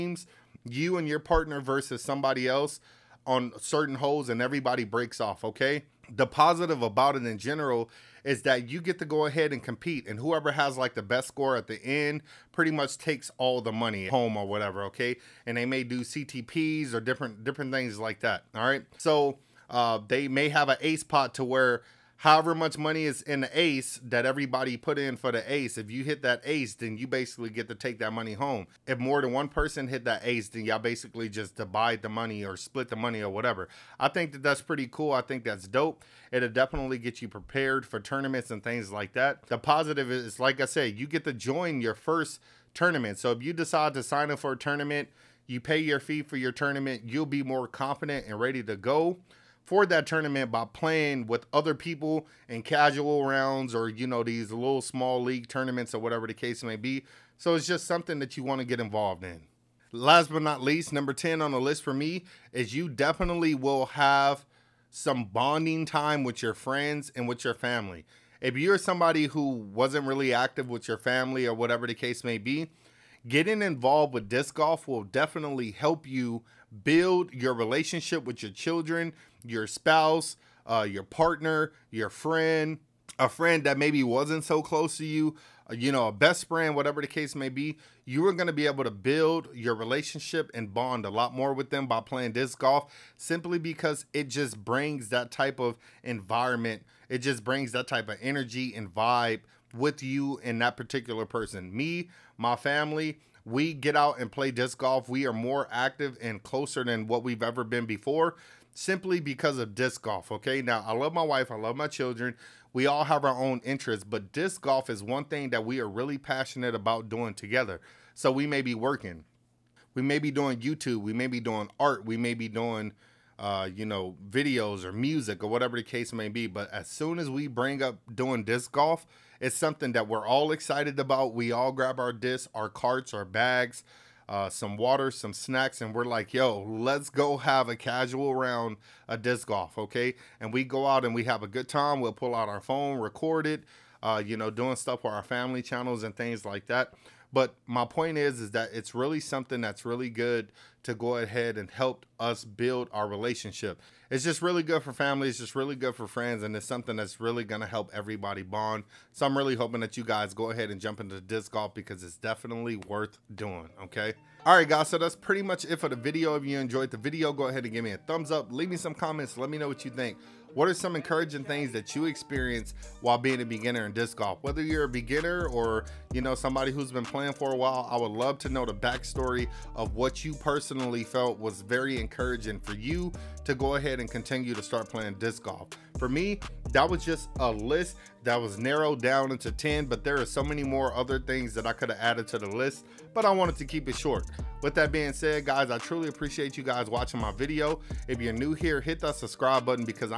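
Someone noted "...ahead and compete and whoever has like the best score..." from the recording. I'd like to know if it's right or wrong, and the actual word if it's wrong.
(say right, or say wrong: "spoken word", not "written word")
right.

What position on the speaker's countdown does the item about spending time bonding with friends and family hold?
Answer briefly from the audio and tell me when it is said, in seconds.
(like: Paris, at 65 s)
10, at 60 s.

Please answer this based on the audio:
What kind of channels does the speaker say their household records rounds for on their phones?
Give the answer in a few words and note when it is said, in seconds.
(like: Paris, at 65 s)
Family channels, at 145 s.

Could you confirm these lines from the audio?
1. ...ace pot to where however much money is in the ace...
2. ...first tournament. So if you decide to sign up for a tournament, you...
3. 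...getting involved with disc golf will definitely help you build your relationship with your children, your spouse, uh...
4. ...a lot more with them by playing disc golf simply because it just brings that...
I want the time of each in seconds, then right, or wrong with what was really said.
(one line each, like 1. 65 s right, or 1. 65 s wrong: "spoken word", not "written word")
1. 20 s right
2. 41 s right
3. 73 s right
4. 91 s right.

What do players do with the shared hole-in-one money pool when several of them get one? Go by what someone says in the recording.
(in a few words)
Split the money.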